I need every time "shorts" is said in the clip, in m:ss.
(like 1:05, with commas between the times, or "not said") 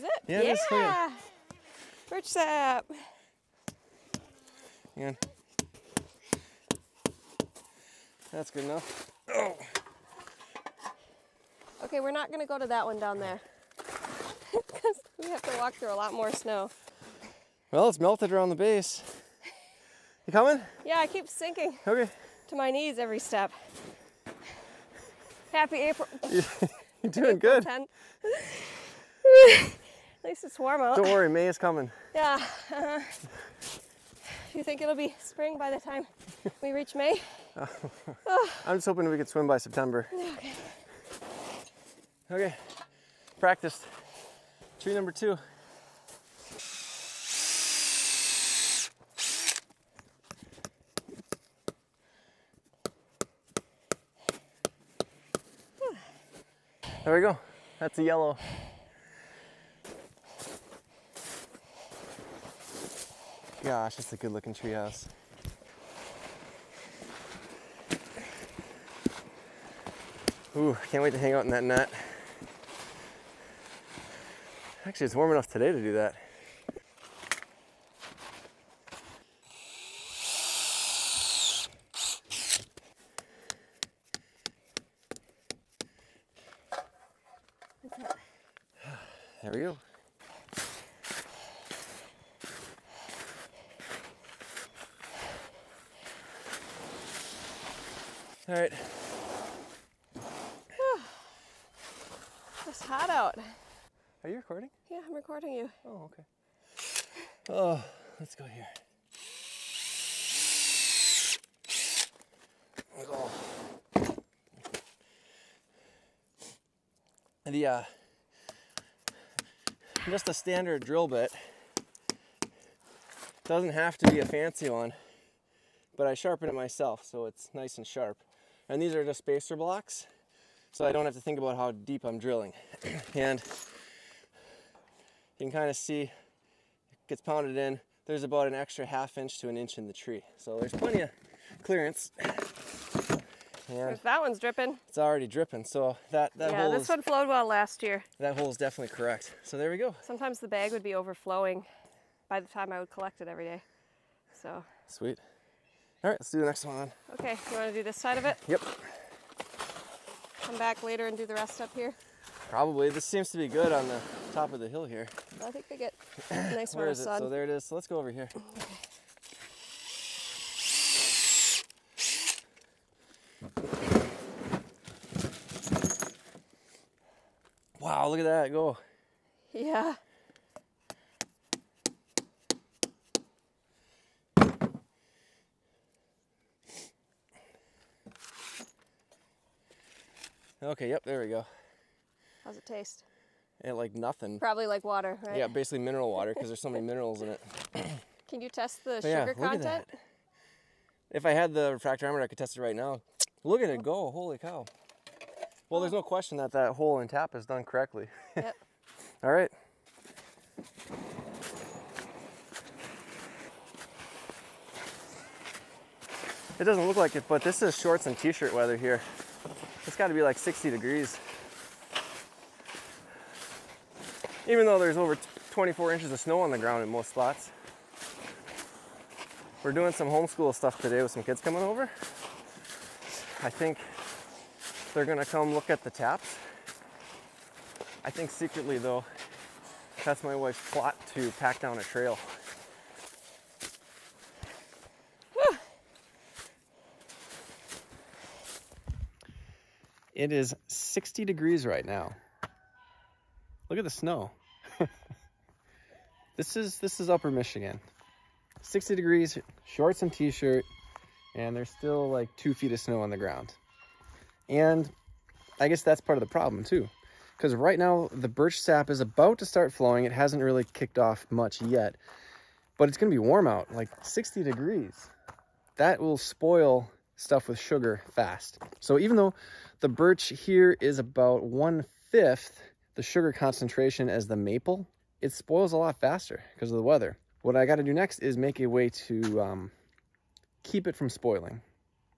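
3:37, 4:19.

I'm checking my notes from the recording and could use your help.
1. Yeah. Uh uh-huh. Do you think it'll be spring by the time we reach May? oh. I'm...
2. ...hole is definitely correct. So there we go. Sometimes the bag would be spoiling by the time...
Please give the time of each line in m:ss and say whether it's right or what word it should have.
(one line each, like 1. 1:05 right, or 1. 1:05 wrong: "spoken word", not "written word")
1. 0:32 right
2. 2:28 wrong: "overflowing", not "spoiling".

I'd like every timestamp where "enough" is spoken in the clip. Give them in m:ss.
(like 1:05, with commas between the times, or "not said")
0:08, 1:15.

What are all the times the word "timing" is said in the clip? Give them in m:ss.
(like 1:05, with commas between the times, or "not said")
not said.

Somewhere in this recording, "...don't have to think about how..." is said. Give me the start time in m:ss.
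2:10.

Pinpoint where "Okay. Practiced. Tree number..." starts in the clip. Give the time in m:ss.
0:42.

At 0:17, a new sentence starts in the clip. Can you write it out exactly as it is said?
Well, it's melted around the base.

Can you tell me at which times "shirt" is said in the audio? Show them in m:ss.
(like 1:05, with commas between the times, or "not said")
3:38, 4:20.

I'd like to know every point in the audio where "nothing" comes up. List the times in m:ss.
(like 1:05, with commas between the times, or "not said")
3:13.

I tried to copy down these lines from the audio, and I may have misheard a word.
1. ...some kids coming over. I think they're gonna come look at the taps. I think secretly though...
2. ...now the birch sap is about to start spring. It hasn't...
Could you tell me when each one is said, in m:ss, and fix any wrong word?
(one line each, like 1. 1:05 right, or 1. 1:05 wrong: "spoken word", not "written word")
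1. 3:51 right
2. 4:27 wrong: "flowing", not "spring".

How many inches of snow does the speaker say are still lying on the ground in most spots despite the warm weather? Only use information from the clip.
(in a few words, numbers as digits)
24 inches.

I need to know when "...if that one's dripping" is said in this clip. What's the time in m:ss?
2:23.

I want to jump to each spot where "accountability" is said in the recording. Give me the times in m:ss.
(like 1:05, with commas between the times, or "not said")
not said.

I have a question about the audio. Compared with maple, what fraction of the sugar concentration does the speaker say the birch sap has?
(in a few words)
One fifth.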